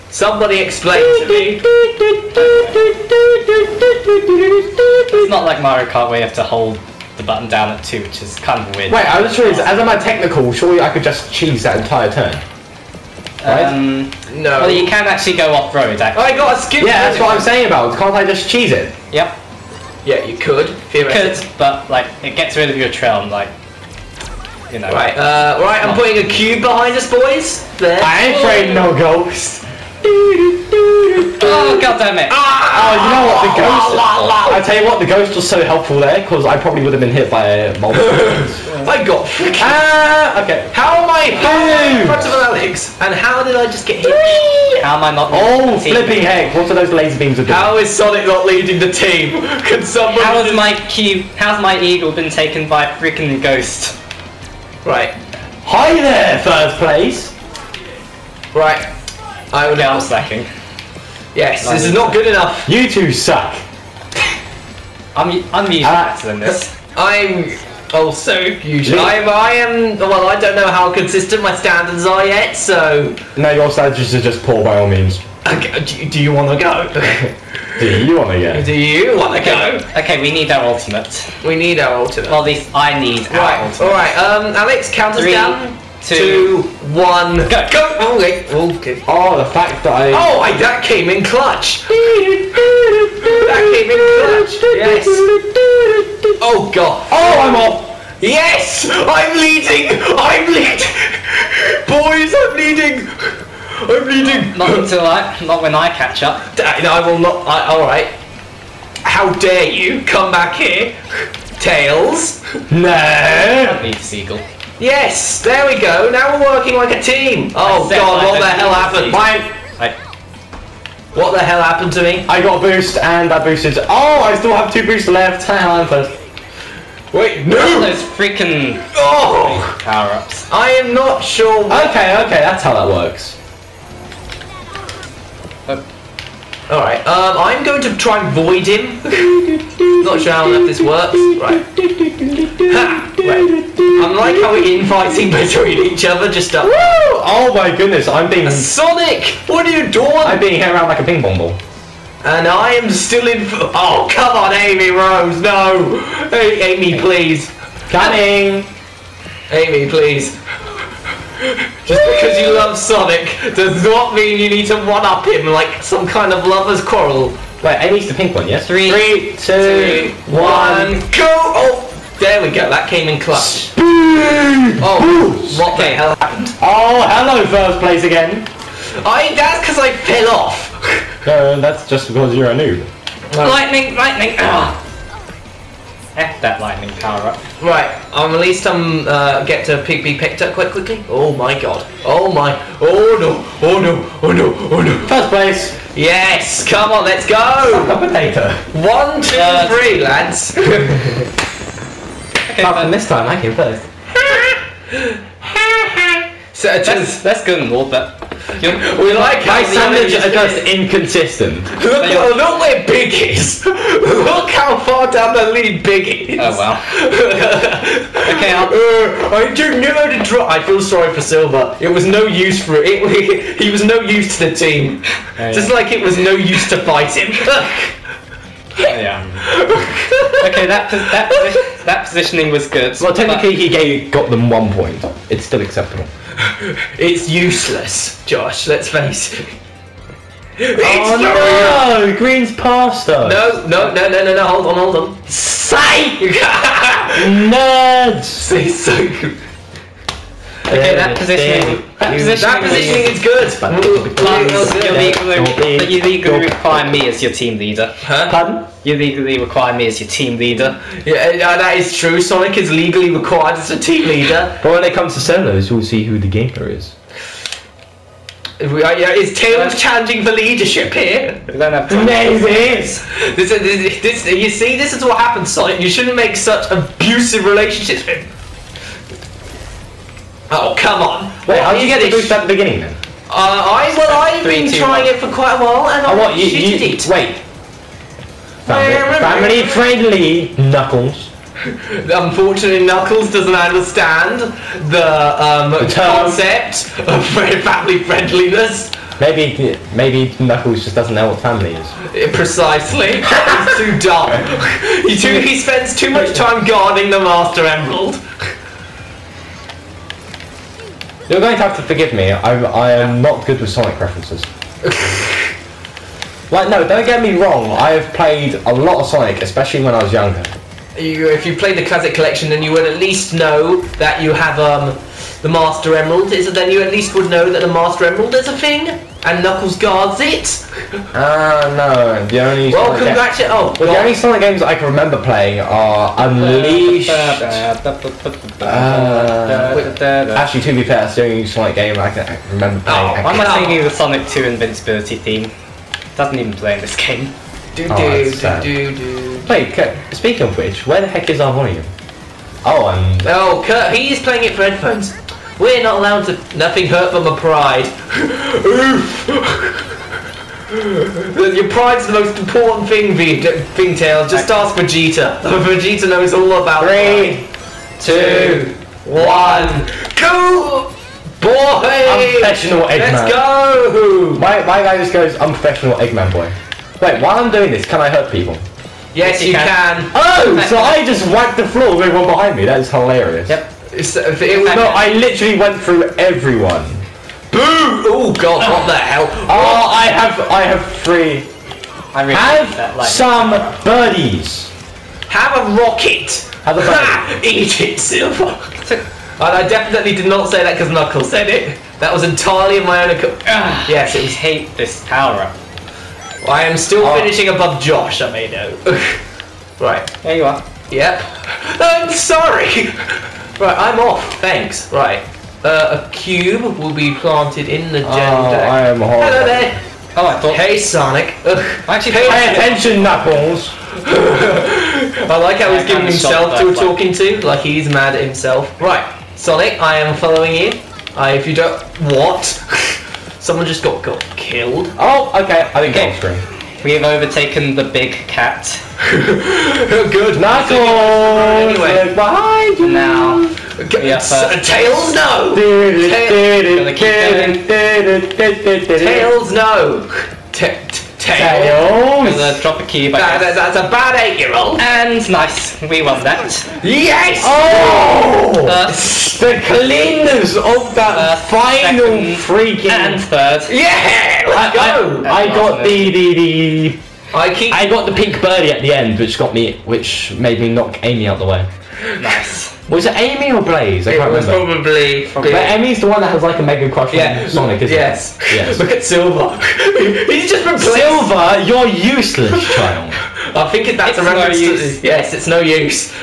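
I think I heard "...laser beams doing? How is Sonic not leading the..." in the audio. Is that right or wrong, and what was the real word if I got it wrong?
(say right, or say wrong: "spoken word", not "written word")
right.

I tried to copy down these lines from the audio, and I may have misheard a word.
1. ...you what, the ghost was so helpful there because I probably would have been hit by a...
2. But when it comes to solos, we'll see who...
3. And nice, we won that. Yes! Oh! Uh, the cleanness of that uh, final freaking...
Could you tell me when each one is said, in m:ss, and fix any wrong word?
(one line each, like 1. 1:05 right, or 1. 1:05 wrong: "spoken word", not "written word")
1. 0:34 right
2. 4:24 right
3. 7:34 right.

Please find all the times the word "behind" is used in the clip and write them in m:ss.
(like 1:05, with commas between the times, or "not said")
0:26, 6:22, 7:22.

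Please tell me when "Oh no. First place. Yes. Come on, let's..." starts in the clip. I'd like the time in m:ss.
3:14.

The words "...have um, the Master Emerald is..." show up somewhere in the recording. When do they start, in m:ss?
5:24.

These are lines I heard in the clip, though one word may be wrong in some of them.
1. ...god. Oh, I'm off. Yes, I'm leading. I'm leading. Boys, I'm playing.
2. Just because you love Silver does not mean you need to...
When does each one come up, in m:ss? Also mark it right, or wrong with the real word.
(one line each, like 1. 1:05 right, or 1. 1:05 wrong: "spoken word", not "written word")
1. 1:36 wrong: "leading", not "playing"
2. 2:41 wrong: "Sonic", not "Silver".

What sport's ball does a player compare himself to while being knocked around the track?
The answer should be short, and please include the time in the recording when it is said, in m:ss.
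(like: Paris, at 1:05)
Ping pong, at 2:31.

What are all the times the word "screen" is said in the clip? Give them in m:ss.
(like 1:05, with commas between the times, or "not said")
7:16.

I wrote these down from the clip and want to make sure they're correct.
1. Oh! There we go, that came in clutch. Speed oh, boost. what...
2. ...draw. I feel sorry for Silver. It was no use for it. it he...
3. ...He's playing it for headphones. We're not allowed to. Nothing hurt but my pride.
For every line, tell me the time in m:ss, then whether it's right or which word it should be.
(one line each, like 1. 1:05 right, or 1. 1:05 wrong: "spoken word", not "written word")
1. 2:51 right
2. 3:40 right
3. 5:53 right.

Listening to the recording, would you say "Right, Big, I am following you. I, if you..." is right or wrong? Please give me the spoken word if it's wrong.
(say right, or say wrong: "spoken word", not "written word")
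wrong: "Sonic", not "Big".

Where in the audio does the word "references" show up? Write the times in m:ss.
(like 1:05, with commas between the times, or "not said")
5:13, 8:04.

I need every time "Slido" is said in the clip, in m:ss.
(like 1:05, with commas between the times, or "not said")
not said.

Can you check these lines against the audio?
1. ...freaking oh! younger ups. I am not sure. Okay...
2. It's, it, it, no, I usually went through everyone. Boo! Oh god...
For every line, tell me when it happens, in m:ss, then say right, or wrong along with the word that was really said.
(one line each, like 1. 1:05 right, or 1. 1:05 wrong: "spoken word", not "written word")
1. 2:08 wrong: "power", not "younger"
2. 6:23 wrong: "literally", not "usually".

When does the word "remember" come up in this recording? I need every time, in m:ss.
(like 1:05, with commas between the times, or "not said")
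5:34, 5:42, 7:54.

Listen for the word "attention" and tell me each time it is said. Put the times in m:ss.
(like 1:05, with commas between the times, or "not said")
7:02.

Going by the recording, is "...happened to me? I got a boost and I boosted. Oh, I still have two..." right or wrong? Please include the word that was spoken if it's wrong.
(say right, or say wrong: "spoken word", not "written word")
right.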